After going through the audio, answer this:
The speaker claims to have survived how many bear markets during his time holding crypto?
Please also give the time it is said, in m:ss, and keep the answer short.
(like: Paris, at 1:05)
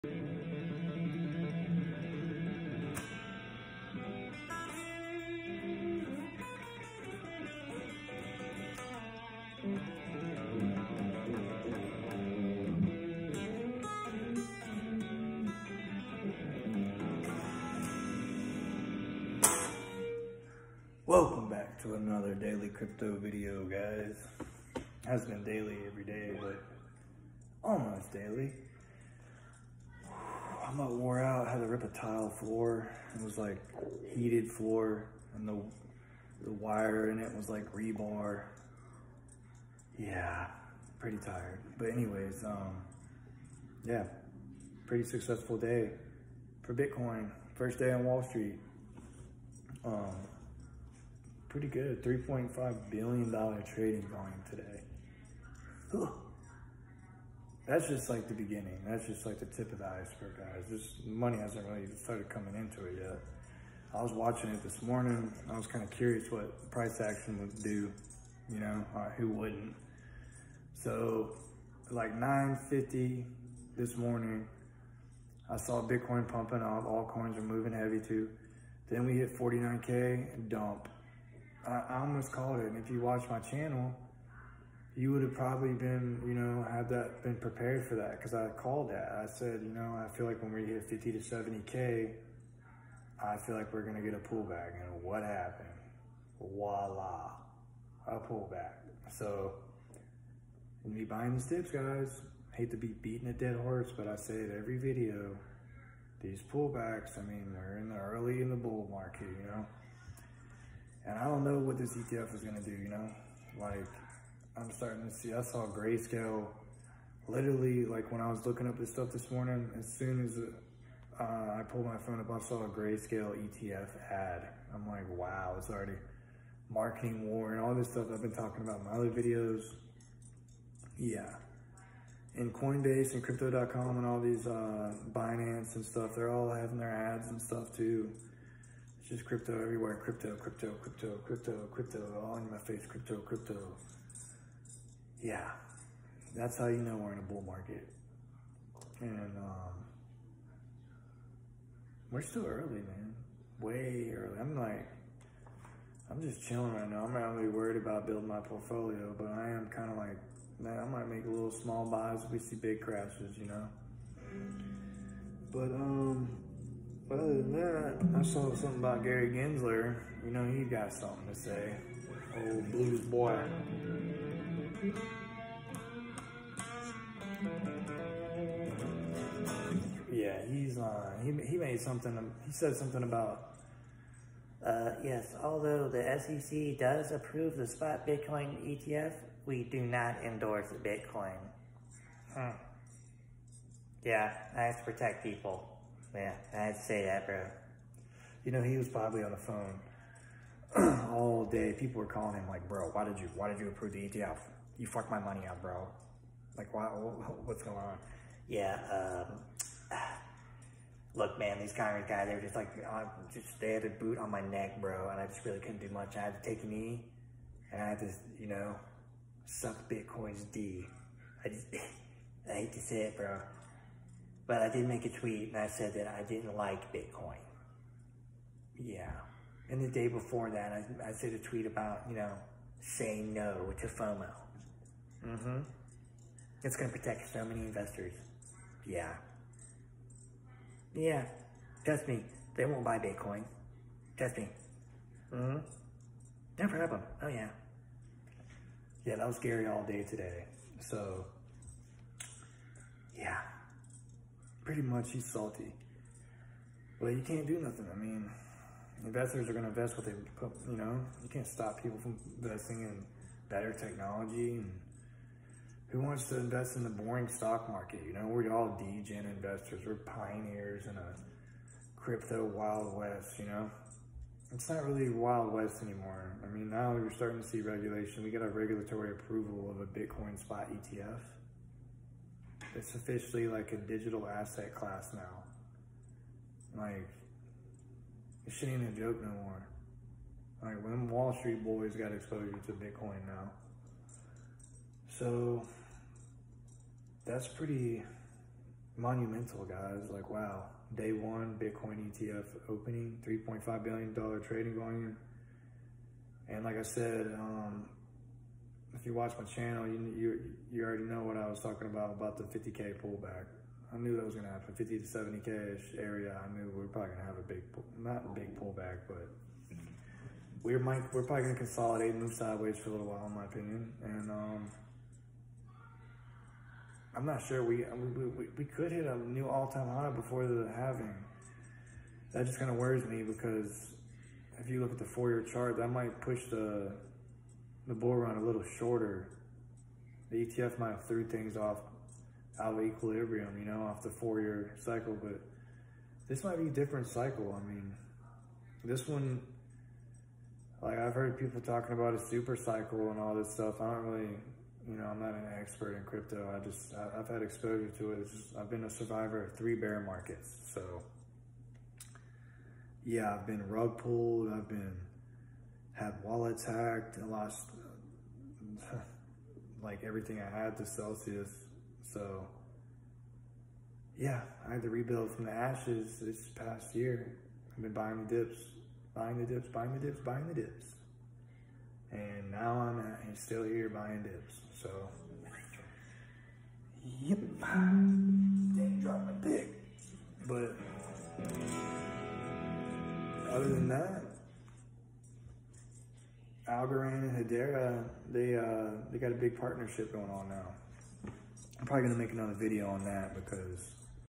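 3, at 5:59.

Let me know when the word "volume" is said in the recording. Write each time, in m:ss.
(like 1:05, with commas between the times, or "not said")
0:54, 5:04.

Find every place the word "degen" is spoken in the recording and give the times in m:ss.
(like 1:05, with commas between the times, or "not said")
4:28.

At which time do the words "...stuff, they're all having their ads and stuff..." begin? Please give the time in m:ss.
2:15.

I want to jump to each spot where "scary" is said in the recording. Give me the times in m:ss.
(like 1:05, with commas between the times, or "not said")
4:09.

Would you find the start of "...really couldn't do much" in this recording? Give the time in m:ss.
3:35.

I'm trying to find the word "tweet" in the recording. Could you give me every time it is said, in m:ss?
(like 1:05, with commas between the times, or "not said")
3:45, 3:51.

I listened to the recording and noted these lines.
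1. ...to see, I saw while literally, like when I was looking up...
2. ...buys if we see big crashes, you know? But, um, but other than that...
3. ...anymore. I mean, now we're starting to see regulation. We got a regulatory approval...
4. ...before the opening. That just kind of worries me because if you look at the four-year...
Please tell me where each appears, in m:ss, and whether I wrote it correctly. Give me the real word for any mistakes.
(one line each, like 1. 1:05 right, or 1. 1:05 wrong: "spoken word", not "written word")
1. 1:55 wrong: "grayscale", not "while"
2. 2:41 right
3. 4:35 right
4. 5:30 wrong: "halving", not "opening".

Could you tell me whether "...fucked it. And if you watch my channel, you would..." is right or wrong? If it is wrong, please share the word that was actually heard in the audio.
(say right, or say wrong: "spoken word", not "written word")
wrong: "called", not "fucked".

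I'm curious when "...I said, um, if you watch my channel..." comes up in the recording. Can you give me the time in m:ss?
5:06.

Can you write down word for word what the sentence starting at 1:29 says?
I said, you know, I feel like when we hit 50 to 70K, I feel like we're going to get a pullback.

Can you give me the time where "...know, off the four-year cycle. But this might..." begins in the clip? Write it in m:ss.
5:43.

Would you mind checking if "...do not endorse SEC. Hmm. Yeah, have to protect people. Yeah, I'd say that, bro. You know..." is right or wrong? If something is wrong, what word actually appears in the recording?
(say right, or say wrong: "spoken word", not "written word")
wrong: "Bitcoin", not "SEC".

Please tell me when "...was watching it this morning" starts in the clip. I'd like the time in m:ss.
1:04.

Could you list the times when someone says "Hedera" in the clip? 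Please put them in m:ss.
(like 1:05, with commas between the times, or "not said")
6:37.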